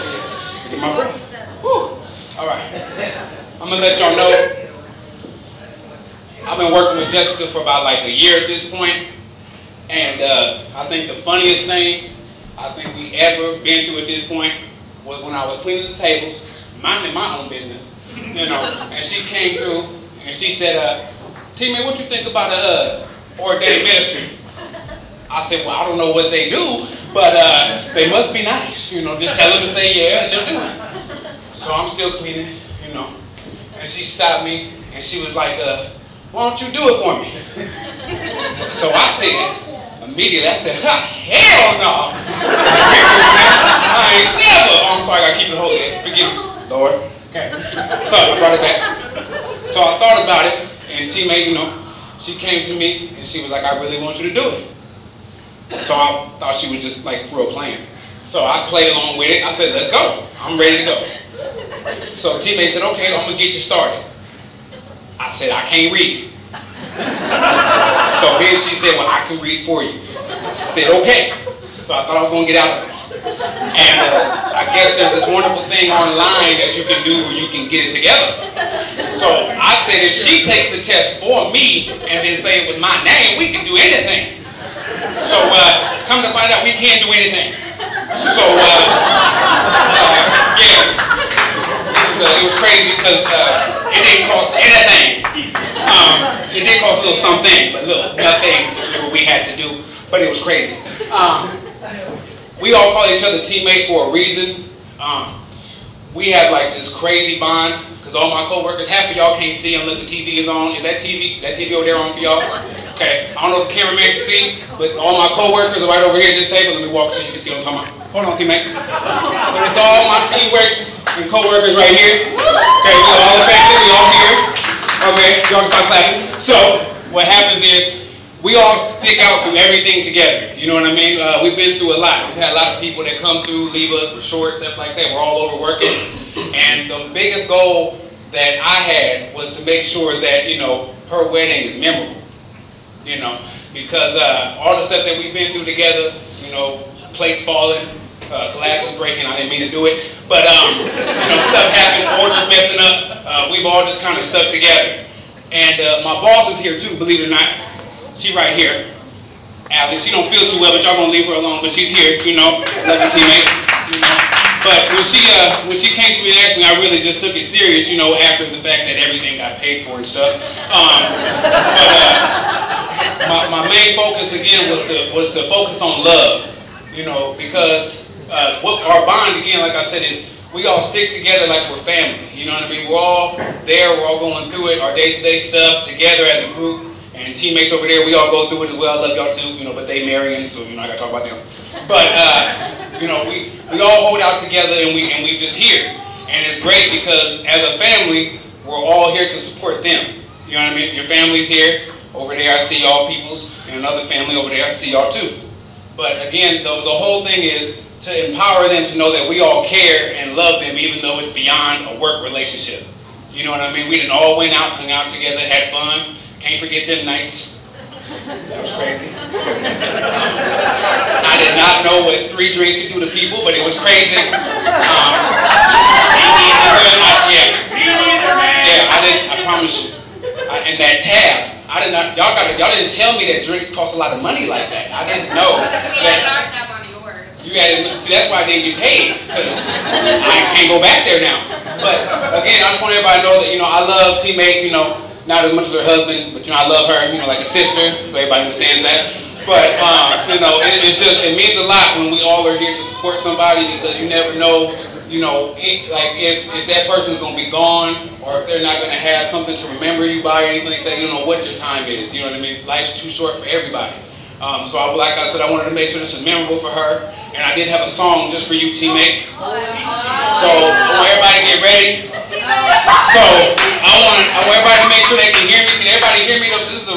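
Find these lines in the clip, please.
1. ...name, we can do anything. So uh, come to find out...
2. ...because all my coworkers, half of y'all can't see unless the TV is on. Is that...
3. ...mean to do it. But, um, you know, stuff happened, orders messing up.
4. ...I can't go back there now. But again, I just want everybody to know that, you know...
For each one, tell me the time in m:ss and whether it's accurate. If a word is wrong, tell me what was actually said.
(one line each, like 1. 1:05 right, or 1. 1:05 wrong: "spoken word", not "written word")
1. 1:23 right
2. 1:47 right
3. 2:29 right
4. 3:59 right.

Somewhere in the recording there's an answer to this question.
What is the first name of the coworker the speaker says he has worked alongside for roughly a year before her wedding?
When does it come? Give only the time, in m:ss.
0:07.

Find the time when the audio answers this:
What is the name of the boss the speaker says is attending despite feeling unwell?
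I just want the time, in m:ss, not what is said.
2:39.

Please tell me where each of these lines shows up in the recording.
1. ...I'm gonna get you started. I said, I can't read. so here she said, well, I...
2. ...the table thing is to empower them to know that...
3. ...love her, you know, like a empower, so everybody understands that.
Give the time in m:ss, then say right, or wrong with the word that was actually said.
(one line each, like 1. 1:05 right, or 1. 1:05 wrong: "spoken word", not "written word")
1. 1:03 right
2. 3:26 wrong: "whole", not "table"
3. 4:06 wrong: "sister", not "empower".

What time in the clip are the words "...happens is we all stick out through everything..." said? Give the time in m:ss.
2:07.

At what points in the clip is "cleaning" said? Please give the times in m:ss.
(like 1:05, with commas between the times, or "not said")
0:15, 0:32.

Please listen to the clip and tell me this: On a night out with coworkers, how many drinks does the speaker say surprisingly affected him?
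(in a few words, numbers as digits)
3.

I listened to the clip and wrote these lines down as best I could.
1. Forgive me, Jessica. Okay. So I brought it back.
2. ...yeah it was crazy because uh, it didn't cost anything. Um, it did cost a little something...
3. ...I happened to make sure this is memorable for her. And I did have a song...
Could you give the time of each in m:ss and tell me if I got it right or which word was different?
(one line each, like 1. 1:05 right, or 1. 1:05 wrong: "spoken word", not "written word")
1. 0:45 wrong: "Lord", not "Jessica"
2. 1:30 right
3. 4:25 wrong: "wanted", not "happened".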